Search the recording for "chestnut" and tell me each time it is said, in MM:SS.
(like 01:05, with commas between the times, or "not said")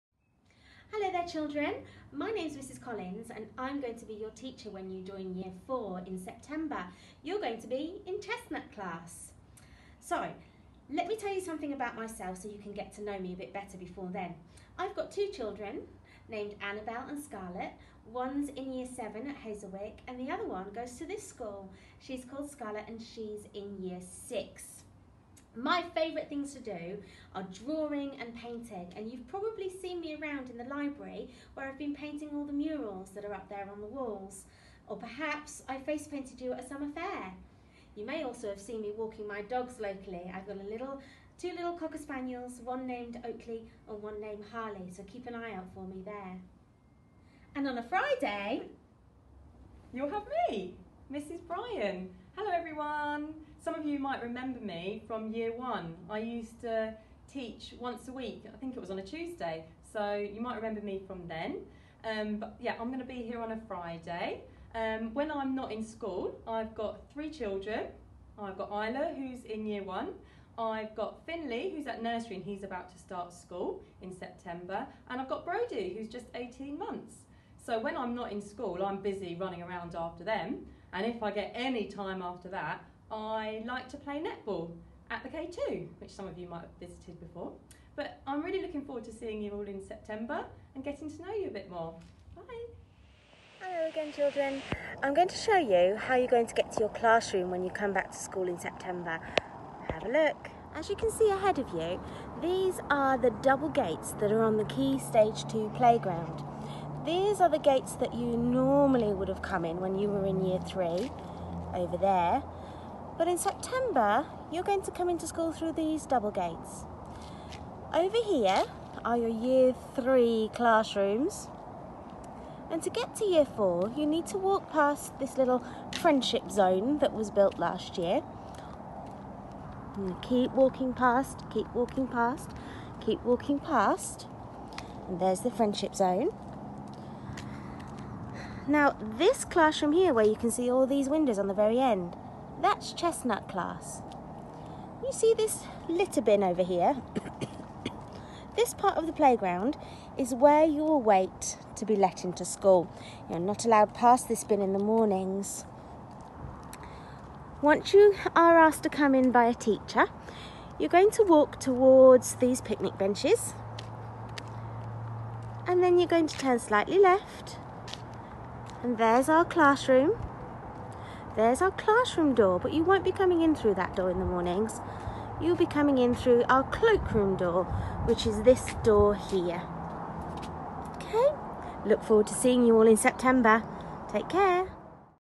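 00:08, 02:22.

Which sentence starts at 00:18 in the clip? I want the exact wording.
One's in year seven at Hazelwick and the other one goes to this school.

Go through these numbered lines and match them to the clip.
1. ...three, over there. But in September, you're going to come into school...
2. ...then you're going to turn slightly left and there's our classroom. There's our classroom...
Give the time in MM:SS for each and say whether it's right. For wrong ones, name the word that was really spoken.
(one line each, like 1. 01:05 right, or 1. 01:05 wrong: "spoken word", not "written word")
1. 01:50 right
2. 02:45 right.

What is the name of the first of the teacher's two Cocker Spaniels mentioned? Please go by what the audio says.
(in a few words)
Oakley.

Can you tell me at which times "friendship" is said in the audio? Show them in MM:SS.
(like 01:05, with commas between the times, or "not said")
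02:05, 02:15.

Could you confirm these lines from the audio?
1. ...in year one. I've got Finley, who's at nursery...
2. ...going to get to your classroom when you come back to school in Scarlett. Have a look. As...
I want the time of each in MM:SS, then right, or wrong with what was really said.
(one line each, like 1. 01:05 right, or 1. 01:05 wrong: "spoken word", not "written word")
1. 01:09 right
2. 01:36 wrong: "September", not "Scarlett".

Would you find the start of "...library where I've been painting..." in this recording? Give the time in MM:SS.
00:30.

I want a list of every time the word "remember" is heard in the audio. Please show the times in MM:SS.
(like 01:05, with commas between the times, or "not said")
00:54, 01:00.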